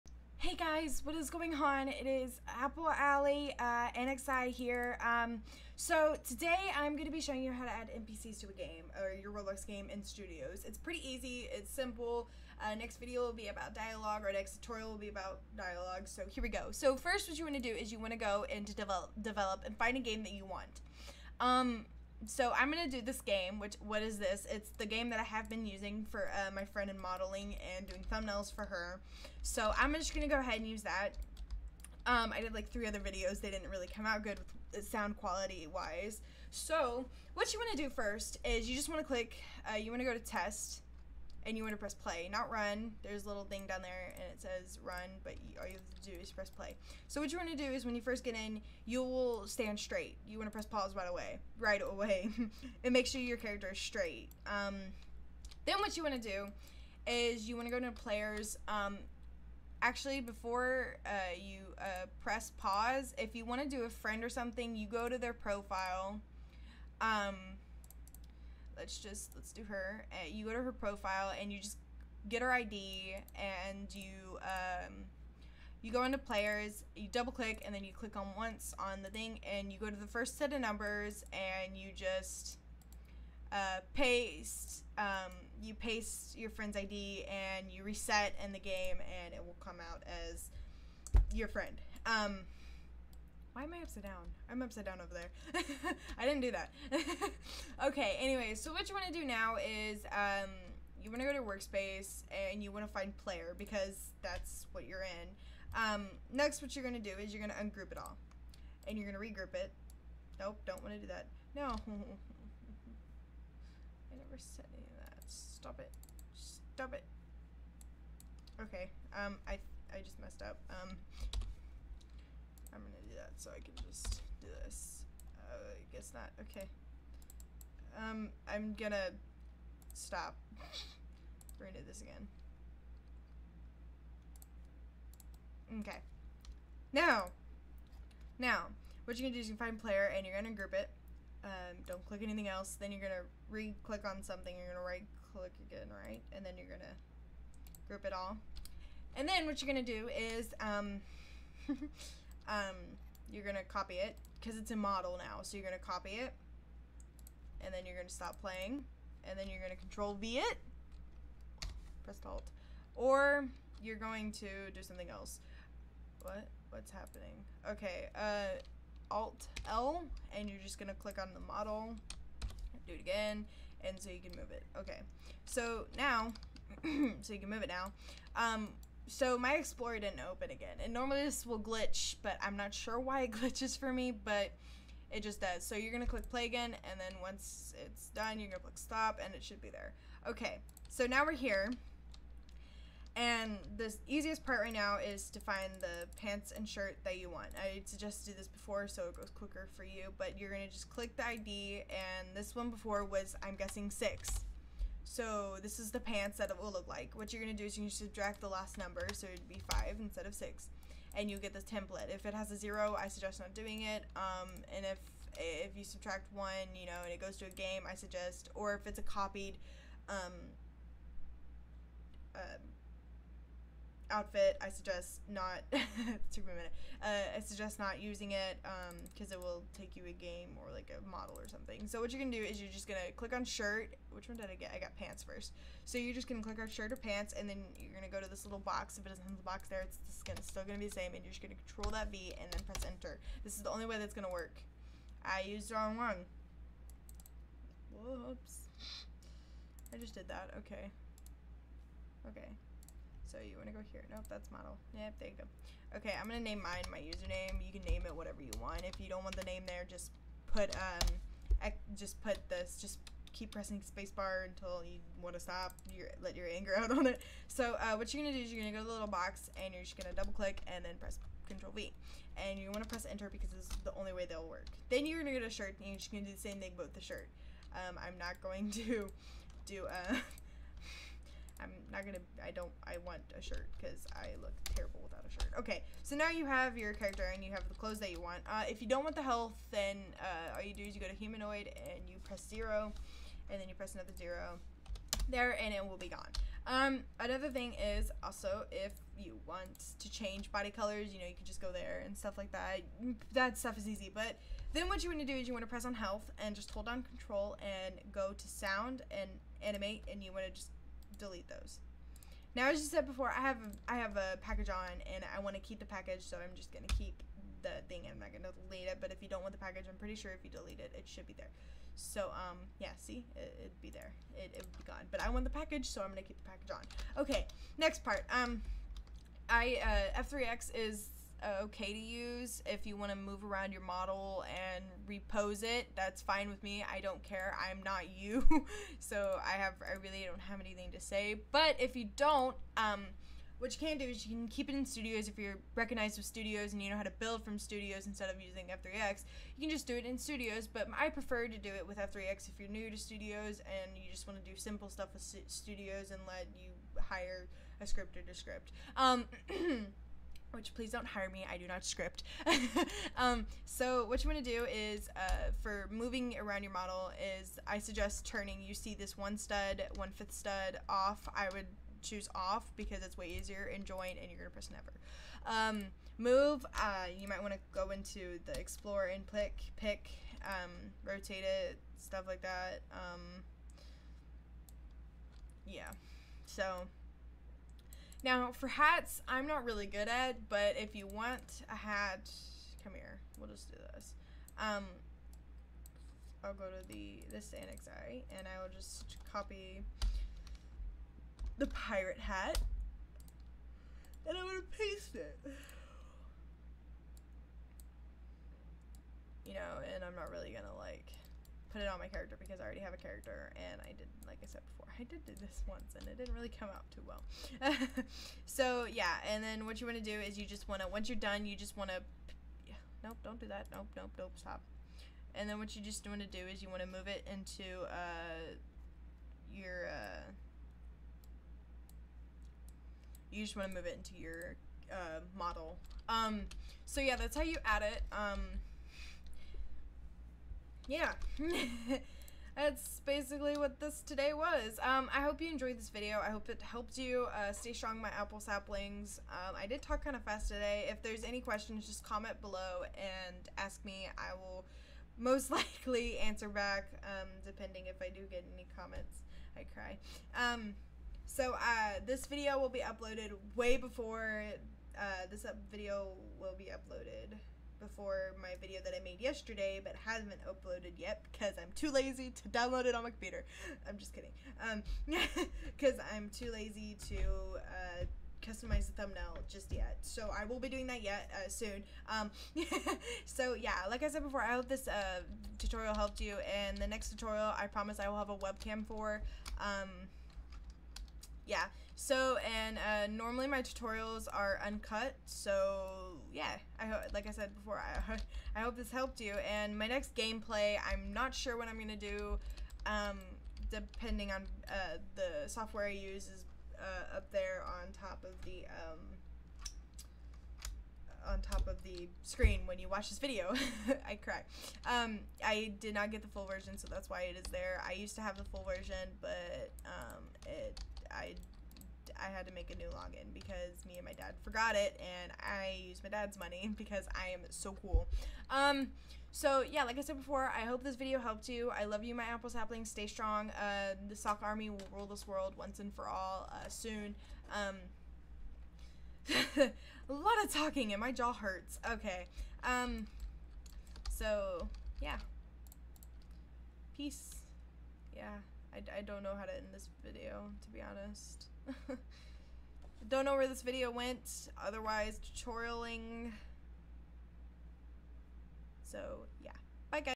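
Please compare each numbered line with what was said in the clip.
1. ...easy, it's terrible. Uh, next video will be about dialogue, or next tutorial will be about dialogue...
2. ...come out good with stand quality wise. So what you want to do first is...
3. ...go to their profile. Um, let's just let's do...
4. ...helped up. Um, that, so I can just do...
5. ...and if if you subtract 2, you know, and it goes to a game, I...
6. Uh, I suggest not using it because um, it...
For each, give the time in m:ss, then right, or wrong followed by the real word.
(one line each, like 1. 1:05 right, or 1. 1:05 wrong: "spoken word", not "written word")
1. 0:11 wrong: "simple", not "terrible"
2. 0:33 wrong: "sound", not "stand"
3. 1:04 right
4. 2:00 wrong: "messed", not "helped"
5. 3:34 wrong: "1", not "2"
6. 3:47 right.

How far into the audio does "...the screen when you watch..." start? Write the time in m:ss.
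8:31.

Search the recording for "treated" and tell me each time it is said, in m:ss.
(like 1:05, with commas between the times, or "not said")
not said.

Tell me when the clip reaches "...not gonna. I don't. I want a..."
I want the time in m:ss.
4:42.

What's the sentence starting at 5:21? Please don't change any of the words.
So, um, yeah, see, it, would be there.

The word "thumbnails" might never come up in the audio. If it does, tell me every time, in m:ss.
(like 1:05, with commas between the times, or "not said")
0:28, 7:58.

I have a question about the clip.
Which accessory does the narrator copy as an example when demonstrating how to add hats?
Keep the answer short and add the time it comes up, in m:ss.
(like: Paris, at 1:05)
pirate hat, at 6:39.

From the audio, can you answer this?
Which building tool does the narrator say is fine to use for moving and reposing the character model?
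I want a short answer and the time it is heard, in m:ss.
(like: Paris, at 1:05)
F3X, at 5:30.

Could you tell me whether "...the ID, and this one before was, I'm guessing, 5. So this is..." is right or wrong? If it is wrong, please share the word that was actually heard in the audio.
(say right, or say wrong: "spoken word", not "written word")
wrong: "6", not "5".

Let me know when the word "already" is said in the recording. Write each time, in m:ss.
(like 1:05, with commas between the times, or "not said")
6:52.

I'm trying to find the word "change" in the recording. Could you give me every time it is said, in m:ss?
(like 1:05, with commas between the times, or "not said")
5:00.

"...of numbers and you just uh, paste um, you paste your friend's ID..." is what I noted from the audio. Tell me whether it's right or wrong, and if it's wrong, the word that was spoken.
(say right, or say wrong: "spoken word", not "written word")
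right.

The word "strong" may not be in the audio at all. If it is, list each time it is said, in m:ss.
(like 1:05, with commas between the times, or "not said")
7:27, 8:53.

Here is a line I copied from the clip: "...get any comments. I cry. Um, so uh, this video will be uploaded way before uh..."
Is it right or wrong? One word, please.
right.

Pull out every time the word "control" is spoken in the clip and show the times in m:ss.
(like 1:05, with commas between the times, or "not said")
2:39, 4:01, 4:31, 5:07.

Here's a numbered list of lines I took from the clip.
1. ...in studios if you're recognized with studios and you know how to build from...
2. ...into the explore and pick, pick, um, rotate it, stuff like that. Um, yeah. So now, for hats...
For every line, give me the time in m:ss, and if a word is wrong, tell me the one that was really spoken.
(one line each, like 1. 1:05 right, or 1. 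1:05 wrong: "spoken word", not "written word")
1. 5:44 right
2. 6:17 right.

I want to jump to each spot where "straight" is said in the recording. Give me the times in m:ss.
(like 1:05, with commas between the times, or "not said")
0:49, 0:53.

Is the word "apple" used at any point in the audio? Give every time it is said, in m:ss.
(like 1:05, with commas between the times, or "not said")
0:02, 7:28, 8:52.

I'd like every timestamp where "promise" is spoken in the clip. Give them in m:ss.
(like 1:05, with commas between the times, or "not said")
8:07.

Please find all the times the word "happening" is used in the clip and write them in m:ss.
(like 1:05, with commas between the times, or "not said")
2:46.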